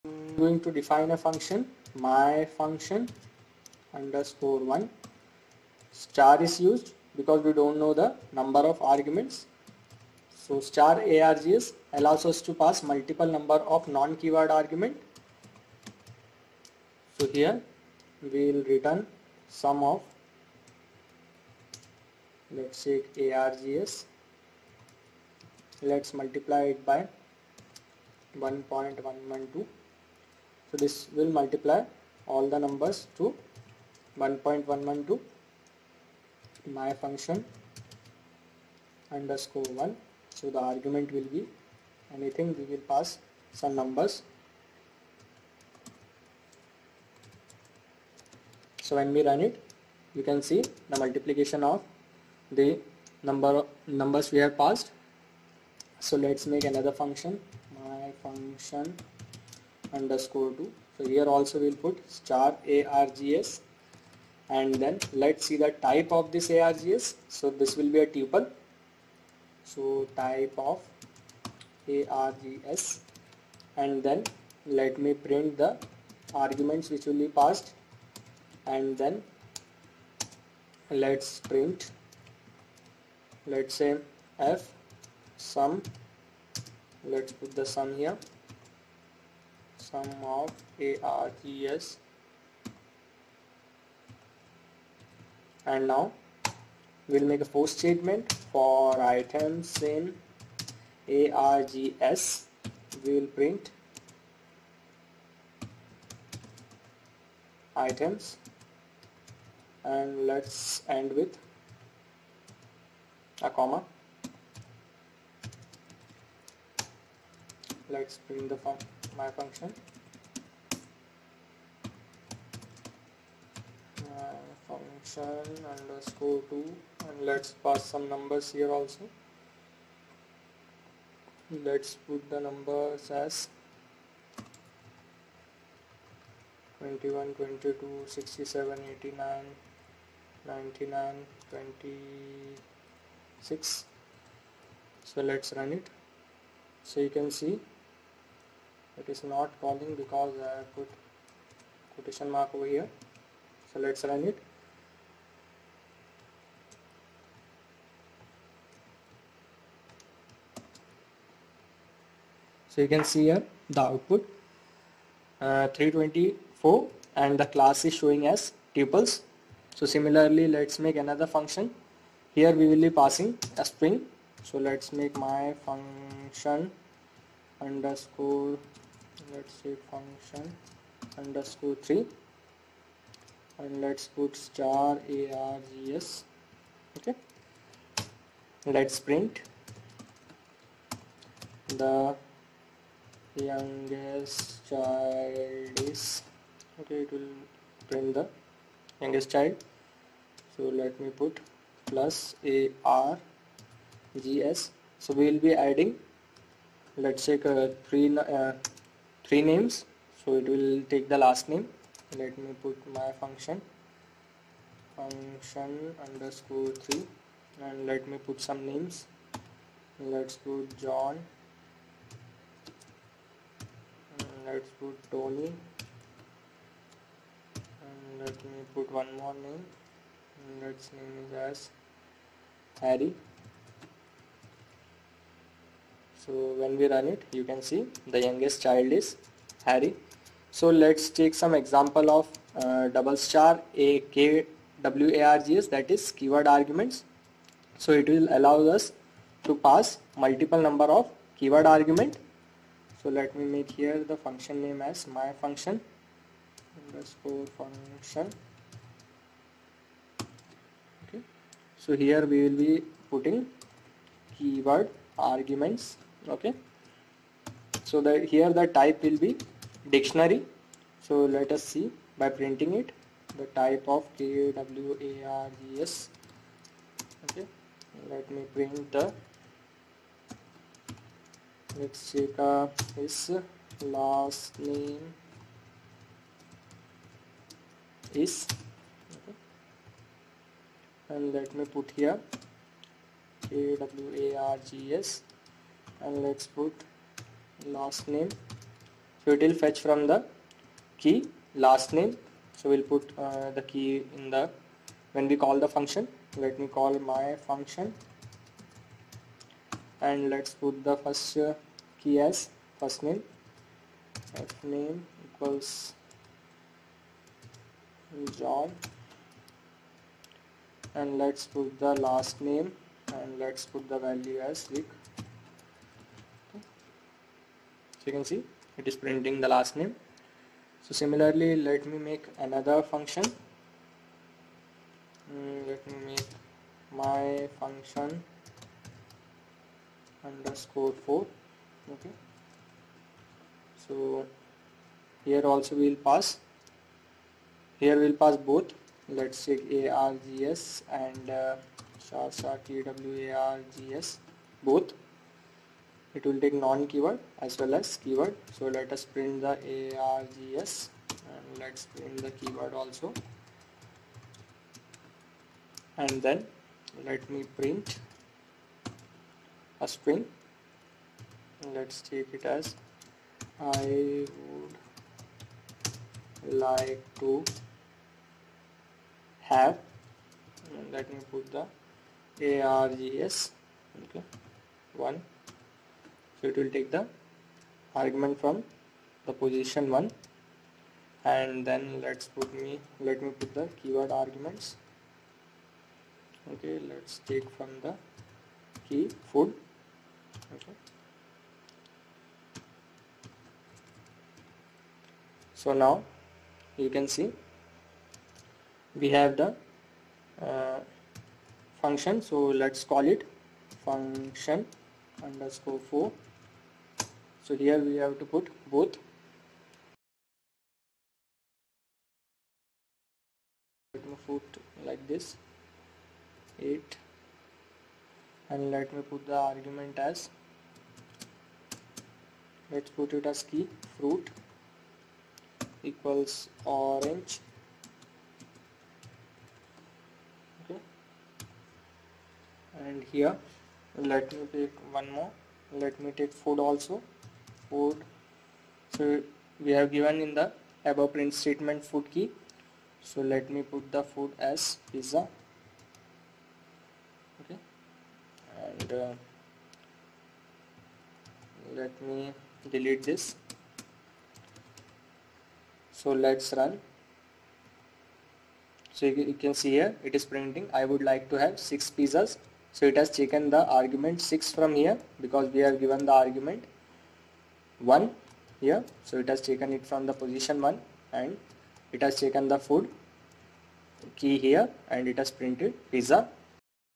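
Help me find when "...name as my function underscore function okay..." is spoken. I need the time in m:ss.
4:14.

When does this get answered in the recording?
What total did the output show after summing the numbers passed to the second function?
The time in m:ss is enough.
2:45.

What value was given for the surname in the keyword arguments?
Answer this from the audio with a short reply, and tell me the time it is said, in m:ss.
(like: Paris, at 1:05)
Rick, at 5:24.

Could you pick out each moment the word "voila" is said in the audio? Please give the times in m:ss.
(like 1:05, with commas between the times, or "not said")
not said.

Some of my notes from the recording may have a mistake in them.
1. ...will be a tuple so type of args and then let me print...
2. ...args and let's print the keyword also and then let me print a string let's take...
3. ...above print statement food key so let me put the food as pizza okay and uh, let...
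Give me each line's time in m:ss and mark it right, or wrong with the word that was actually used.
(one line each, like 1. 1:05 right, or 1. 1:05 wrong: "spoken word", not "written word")
1. 1:07 right
2. 6:00 right
3. 7:30 right.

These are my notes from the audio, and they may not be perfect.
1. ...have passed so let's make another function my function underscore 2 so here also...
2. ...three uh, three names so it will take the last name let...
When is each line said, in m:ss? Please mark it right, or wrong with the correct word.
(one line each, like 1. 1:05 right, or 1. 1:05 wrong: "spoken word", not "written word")
1. 0:54 right
2. 3:27 right.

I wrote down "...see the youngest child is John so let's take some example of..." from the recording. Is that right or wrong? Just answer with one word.
wrong.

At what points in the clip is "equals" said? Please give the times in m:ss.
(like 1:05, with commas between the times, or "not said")
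5:15, 7:15.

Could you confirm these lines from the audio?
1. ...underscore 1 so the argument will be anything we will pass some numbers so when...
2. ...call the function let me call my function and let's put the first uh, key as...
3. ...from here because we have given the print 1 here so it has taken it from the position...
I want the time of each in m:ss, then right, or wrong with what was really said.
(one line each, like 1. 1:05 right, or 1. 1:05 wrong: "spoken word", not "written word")
1. 0:39 right
2. 5:05 right
3. 7:54 wrong: "argument", not "print".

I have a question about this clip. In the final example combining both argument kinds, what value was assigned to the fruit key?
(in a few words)
orange.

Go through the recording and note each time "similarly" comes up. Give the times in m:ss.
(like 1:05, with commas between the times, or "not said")
2:49, 5:30.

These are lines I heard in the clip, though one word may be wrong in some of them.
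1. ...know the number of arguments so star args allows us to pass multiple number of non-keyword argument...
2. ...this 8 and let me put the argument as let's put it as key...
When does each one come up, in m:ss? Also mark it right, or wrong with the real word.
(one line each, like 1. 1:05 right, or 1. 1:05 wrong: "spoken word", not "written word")
1. 0:07 right
2. 7:05 right.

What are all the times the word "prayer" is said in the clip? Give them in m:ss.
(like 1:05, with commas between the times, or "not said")
not said.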